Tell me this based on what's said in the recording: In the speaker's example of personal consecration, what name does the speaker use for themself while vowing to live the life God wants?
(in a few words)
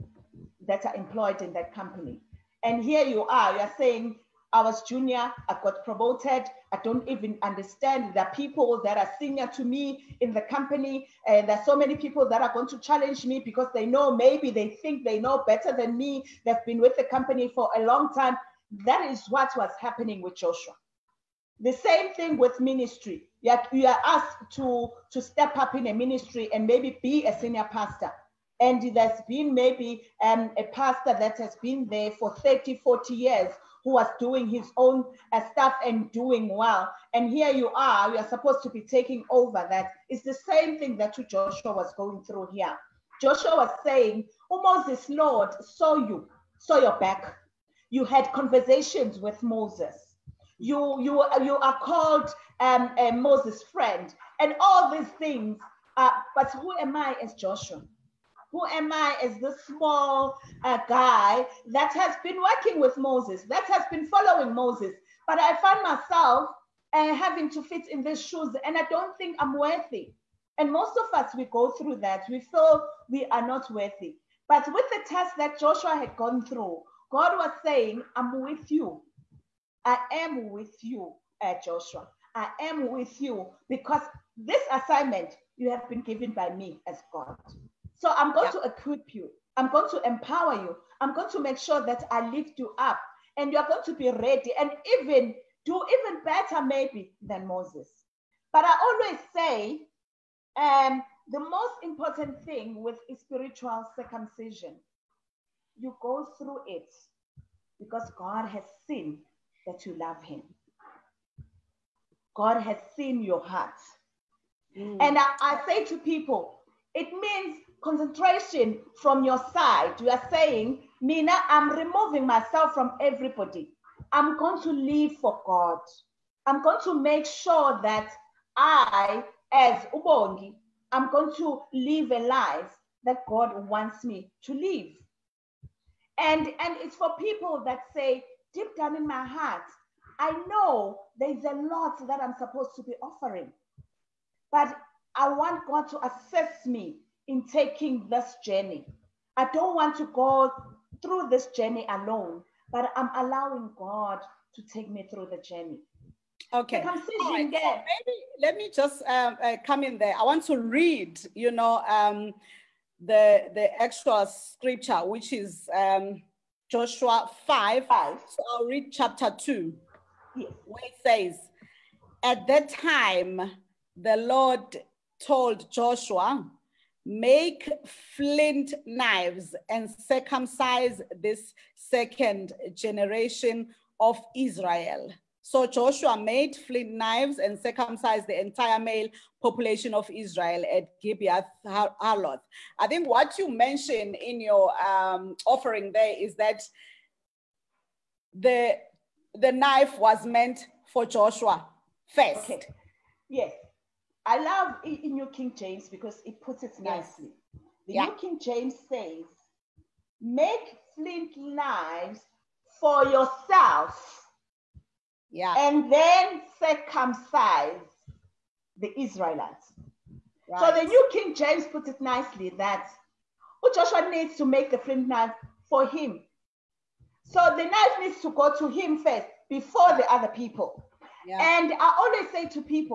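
Ubongi.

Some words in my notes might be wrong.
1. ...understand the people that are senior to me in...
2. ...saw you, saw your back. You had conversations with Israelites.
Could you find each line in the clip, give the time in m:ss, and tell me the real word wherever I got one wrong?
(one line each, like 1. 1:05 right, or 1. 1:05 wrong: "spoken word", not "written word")
1. 0:07 right
2. 0:45 wrong: "Moses", not "Israelites".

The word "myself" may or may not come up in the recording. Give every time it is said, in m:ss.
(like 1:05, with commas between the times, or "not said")
1:05, 2:02.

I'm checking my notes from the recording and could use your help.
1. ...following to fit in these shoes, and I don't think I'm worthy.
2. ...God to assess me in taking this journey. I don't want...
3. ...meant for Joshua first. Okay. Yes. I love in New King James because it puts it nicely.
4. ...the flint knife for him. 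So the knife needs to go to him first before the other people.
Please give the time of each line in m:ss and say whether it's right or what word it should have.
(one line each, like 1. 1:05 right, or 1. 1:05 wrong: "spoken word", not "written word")
1. 1:07 wrong: "having", not "following"
2. 2:25 right
3. 3:20 right
4. 3:44 right.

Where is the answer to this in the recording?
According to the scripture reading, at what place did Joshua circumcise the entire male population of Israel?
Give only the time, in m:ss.
3:11.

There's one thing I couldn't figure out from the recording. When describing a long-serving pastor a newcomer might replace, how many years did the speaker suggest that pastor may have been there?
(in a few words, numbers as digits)
30, 40 years.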